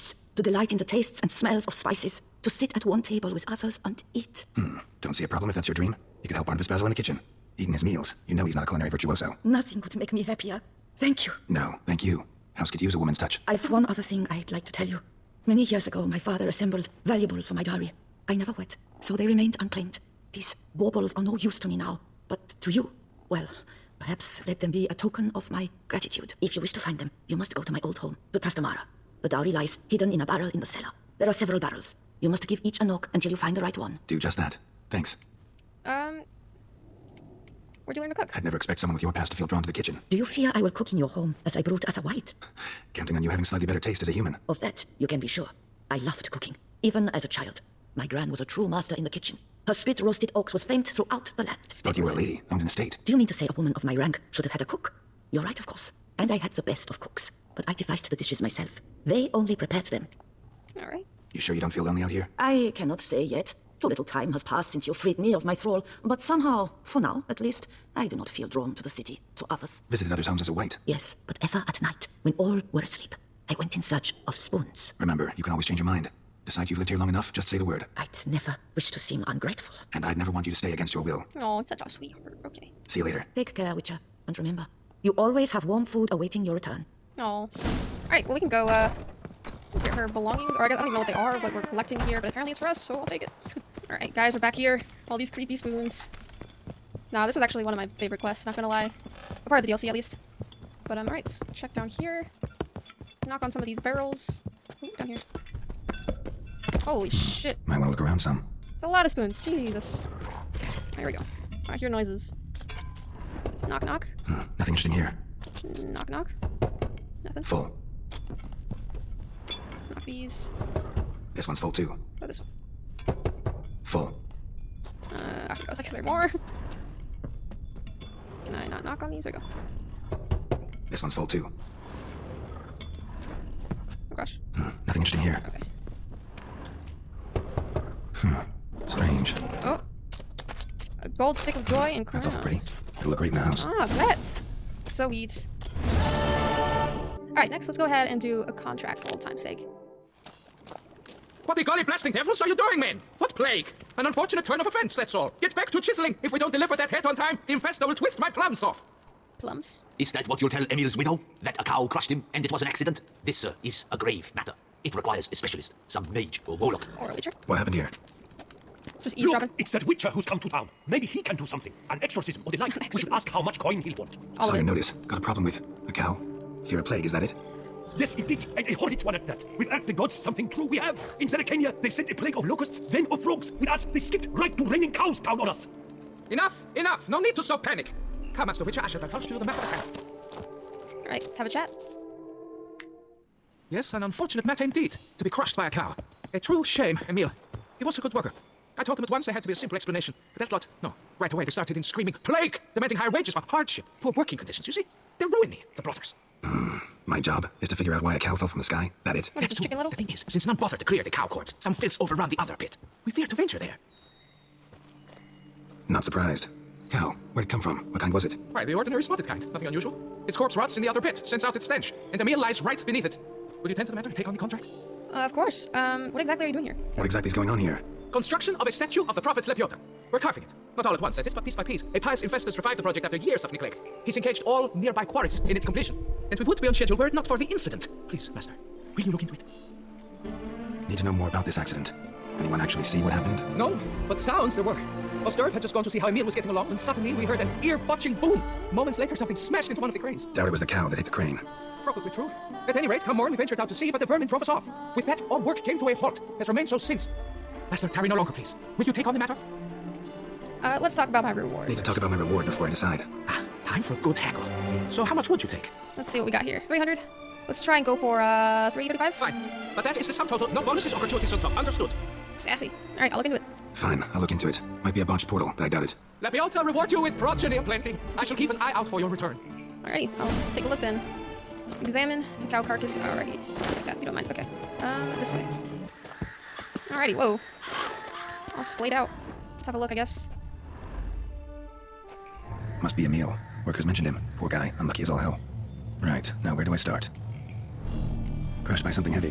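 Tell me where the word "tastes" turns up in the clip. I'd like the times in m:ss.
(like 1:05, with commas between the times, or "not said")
0:00, 0:43.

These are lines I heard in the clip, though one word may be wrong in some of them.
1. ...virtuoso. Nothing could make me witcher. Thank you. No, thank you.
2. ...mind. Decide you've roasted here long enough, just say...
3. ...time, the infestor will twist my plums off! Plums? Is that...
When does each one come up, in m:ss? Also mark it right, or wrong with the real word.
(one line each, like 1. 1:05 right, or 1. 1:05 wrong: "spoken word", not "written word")
1. 0:08 wrong: "happier", not "witcher"
2. 1:15 wrong: "lived", not "roasted"
3. 2:37 right.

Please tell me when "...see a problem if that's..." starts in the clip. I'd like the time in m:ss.
0:05.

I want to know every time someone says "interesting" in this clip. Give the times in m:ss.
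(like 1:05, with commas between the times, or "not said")
1:54, 2:15.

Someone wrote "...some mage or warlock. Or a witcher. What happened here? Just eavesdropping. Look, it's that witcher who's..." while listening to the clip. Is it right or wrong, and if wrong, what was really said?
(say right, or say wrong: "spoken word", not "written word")
right.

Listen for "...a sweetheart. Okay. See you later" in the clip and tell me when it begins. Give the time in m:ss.
1:21.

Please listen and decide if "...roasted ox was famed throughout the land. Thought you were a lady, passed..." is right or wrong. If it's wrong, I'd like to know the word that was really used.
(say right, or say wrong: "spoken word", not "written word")
wrong: "owned", not "passed".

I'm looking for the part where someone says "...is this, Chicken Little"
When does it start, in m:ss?
3:29.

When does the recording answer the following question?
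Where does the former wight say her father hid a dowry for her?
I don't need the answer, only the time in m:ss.
0:28.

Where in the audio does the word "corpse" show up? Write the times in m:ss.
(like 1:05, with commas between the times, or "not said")
3:31, 3:40.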